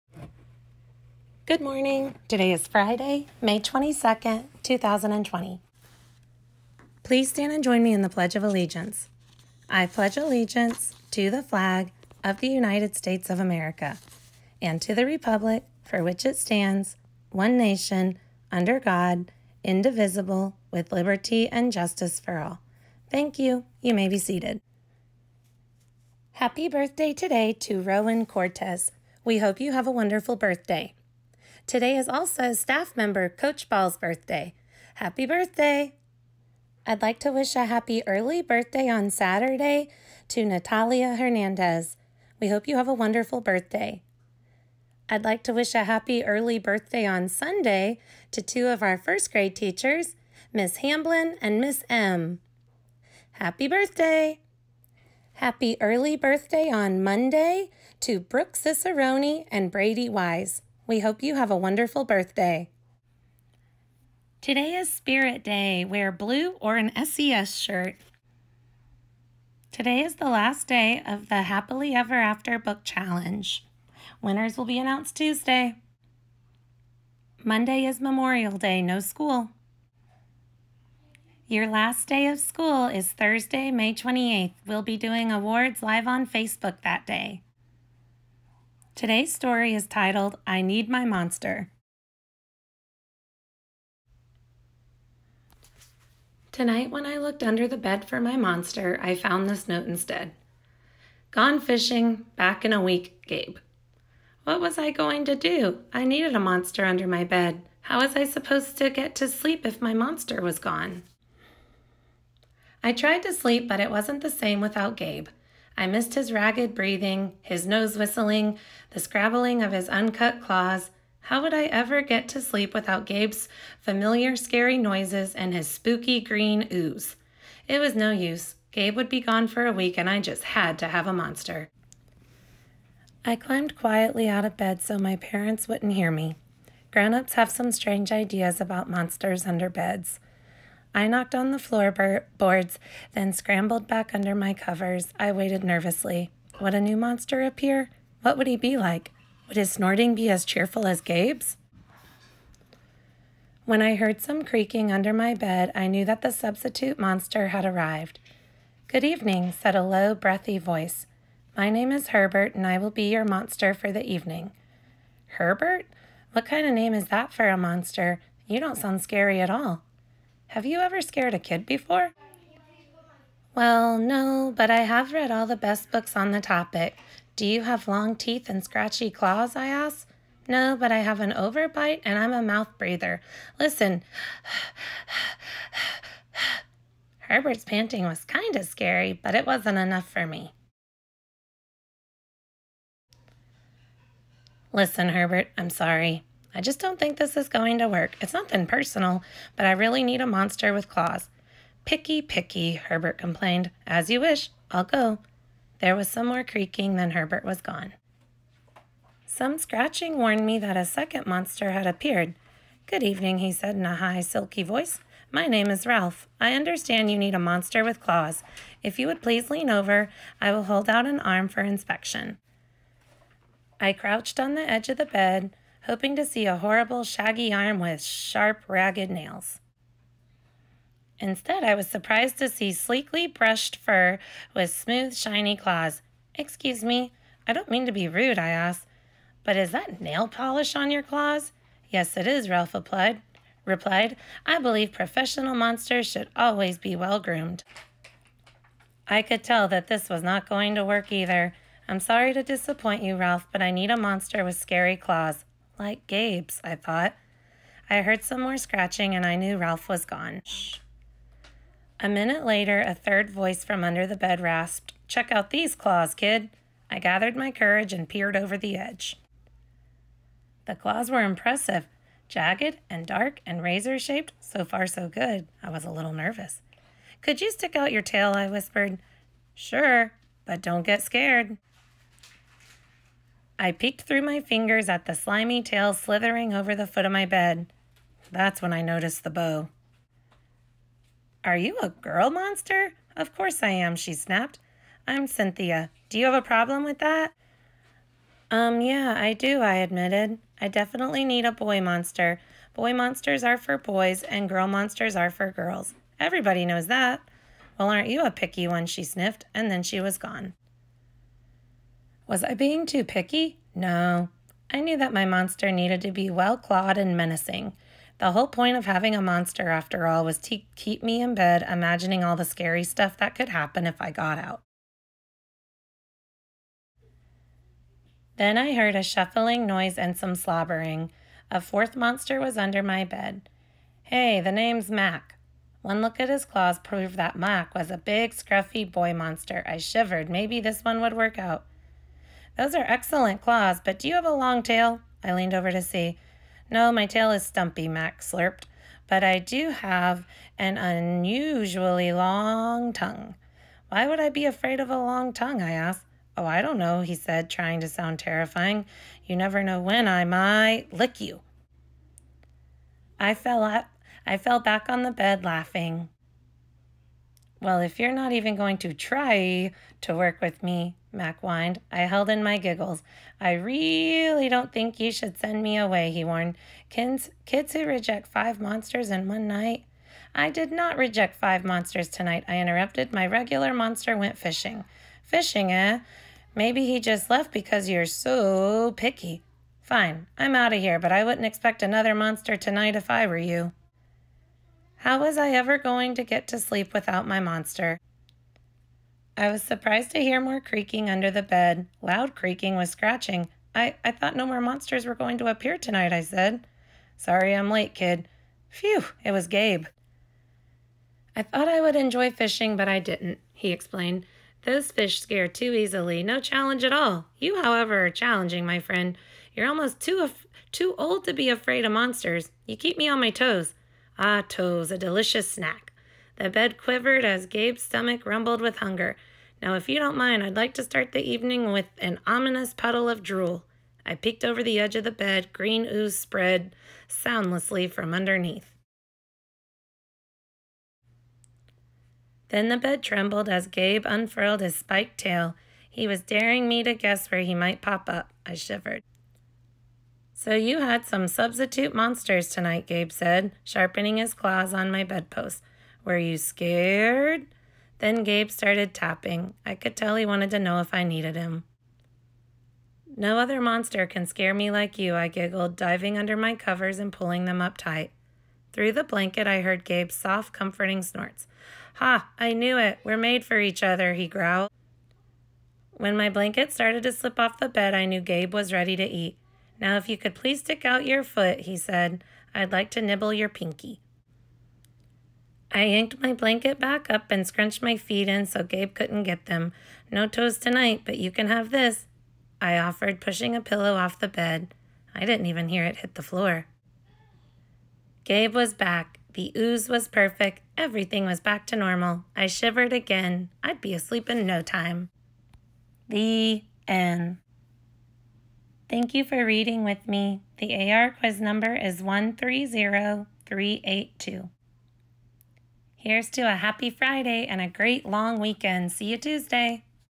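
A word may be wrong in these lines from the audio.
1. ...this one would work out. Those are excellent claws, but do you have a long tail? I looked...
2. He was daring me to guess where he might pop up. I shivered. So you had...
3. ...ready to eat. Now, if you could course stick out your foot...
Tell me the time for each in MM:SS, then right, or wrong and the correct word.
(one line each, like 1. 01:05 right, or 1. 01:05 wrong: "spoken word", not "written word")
1. 05:40 wrong: "leaned", not "looked"
2. 07:25 right
3. 07:58 wrong: "please", not "course".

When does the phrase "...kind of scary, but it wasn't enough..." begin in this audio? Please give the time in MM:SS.
03:08.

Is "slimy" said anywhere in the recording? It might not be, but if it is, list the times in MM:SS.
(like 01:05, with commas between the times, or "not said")
04:45.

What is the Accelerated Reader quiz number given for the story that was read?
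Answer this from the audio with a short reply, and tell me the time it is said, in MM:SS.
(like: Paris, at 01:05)
130382, at 08:32.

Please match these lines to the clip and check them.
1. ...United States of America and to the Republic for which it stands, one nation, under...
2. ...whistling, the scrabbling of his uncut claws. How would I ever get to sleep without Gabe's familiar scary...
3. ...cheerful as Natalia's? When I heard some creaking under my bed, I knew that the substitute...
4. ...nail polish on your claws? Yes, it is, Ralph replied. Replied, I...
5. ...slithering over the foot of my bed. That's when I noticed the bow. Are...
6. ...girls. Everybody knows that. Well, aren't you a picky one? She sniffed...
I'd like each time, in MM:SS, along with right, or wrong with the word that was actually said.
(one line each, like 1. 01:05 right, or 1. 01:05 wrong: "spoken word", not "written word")
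1. 00:12 right
2. 01:57 right
3. 02:30 wrong: "Gabe", not "Natalia"
4. 04:00 right
5. 04:45 right
6. 05:05 right.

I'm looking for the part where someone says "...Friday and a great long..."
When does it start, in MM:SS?
08:36.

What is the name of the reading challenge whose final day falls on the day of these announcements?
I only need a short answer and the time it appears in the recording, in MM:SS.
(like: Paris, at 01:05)
Happily Ever After Book Challenge, at 01:11.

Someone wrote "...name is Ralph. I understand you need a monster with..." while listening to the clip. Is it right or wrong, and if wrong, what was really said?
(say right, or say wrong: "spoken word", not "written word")
right.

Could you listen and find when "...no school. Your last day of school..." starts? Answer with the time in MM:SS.
01:18.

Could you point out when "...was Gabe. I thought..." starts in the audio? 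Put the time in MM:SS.
06:49.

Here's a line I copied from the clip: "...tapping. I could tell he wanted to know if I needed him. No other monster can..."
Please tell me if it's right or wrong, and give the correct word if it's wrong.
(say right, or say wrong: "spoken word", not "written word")
right.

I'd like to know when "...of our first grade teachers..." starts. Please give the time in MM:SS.
00:48.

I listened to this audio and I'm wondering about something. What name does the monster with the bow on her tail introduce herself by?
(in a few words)
Cynthia.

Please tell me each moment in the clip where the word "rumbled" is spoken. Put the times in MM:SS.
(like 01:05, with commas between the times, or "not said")
07:08.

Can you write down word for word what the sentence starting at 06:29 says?
Fine, I'm out of here, but I wouldn't expect another monster tonight if I were you.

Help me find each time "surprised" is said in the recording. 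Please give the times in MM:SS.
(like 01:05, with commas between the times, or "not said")
03:51, 06:39.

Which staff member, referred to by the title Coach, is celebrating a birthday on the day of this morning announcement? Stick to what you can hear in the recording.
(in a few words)
Coach Ball.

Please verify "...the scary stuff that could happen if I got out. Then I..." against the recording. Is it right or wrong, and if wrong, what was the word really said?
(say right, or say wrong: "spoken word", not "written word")
right.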